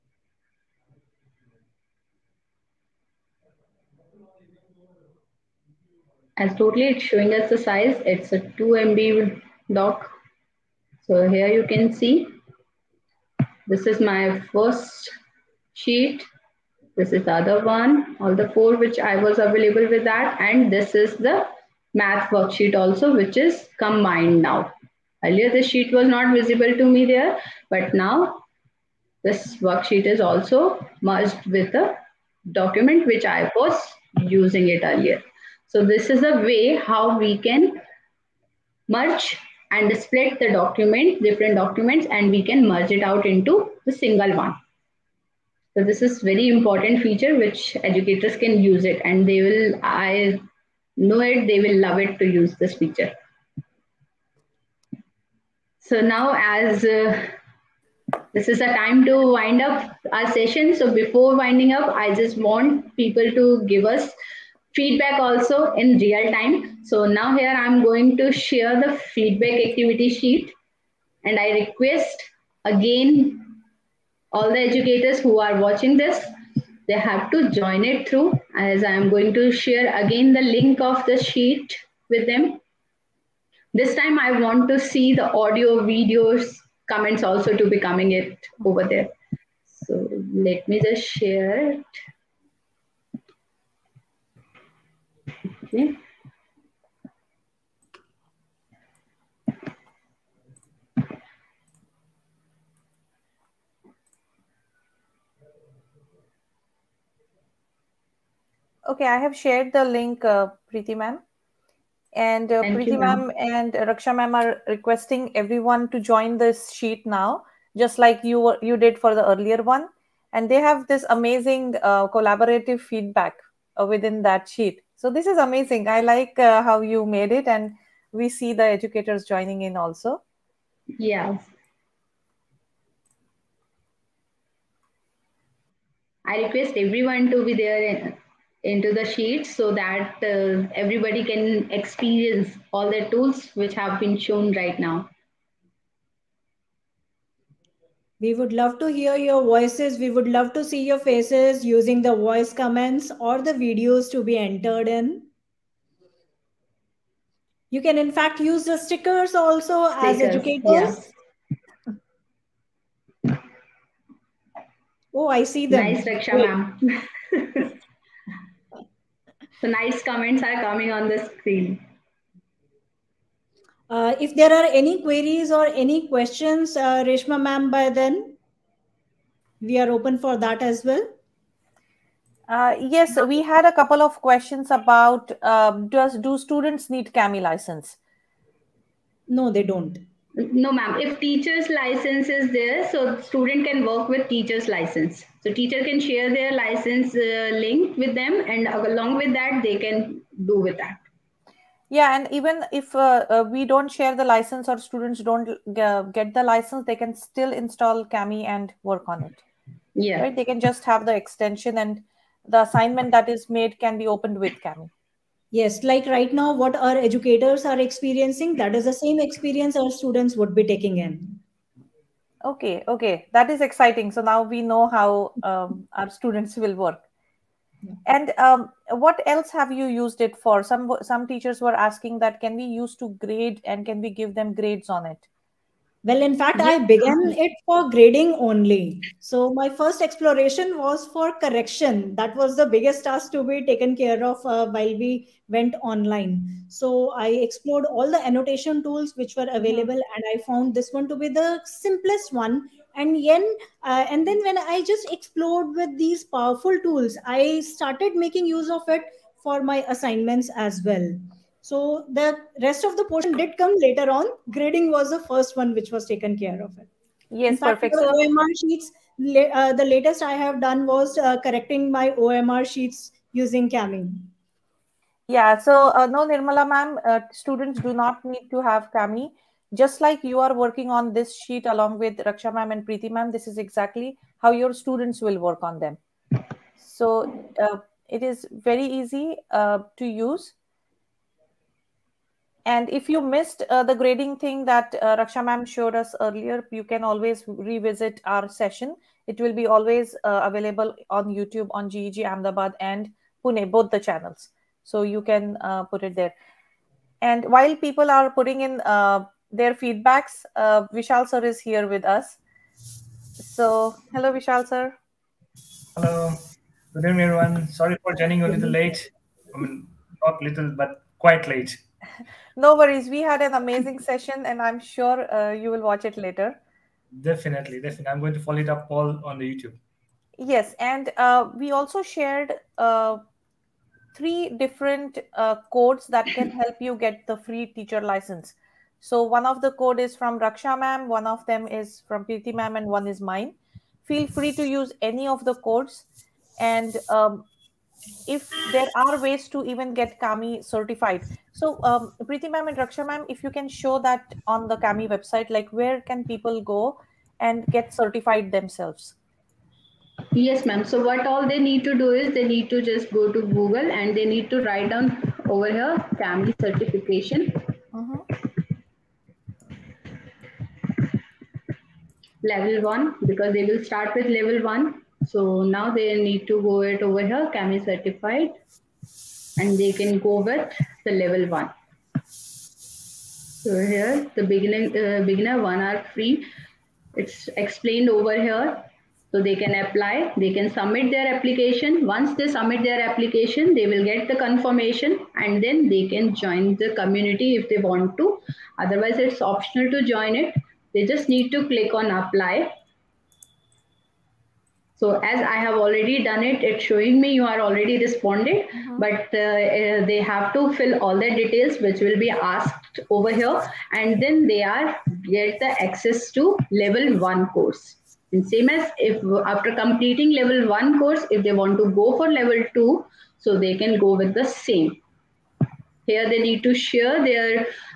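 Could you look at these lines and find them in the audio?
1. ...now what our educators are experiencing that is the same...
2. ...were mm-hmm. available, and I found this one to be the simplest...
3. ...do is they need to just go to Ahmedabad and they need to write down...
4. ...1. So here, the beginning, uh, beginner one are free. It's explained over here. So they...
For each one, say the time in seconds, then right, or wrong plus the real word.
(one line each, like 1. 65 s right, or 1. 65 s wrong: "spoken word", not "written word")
1. 216 s right
2. 249 s right
3. 361 s wrong: "Google", not "Ahmedabad"
4. 381 s right.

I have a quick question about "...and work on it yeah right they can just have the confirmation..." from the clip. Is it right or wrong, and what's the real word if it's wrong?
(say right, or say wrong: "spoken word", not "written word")
wrong: "extension", not "confirmation".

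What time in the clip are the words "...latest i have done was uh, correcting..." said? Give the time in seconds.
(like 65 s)
269 s.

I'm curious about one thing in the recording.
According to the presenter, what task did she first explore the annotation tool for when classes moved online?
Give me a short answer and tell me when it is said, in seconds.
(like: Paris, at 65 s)
Correction, at 241 s.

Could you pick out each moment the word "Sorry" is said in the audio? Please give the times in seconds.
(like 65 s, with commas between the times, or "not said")
317 s.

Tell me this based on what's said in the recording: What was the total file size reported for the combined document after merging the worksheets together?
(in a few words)
2 MB.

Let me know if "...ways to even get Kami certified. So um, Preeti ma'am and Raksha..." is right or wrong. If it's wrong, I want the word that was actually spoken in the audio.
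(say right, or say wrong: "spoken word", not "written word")
right.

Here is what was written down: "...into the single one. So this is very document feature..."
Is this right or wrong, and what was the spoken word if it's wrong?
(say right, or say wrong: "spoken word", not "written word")
wrong: "important", not "document".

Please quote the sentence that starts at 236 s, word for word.
Well, in fact, I began it for grading only.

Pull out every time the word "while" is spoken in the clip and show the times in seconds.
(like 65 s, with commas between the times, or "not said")
244 s, 307 s.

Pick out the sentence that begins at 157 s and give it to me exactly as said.
You can, in fact, use the stickers also stickers, as educators.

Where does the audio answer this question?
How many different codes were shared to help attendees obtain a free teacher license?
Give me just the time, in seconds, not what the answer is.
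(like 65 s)
334 s.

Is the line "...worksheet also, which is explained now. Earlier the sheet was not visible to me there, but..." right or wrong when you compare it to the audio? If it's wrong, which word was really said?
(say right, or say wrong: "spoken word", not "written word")
wrong: "combined", not "explained".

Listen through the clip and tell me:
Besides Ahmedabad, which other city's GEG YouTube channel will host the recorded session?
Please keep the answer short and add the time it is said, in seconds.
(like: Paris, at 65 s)
Pune, at 303 s.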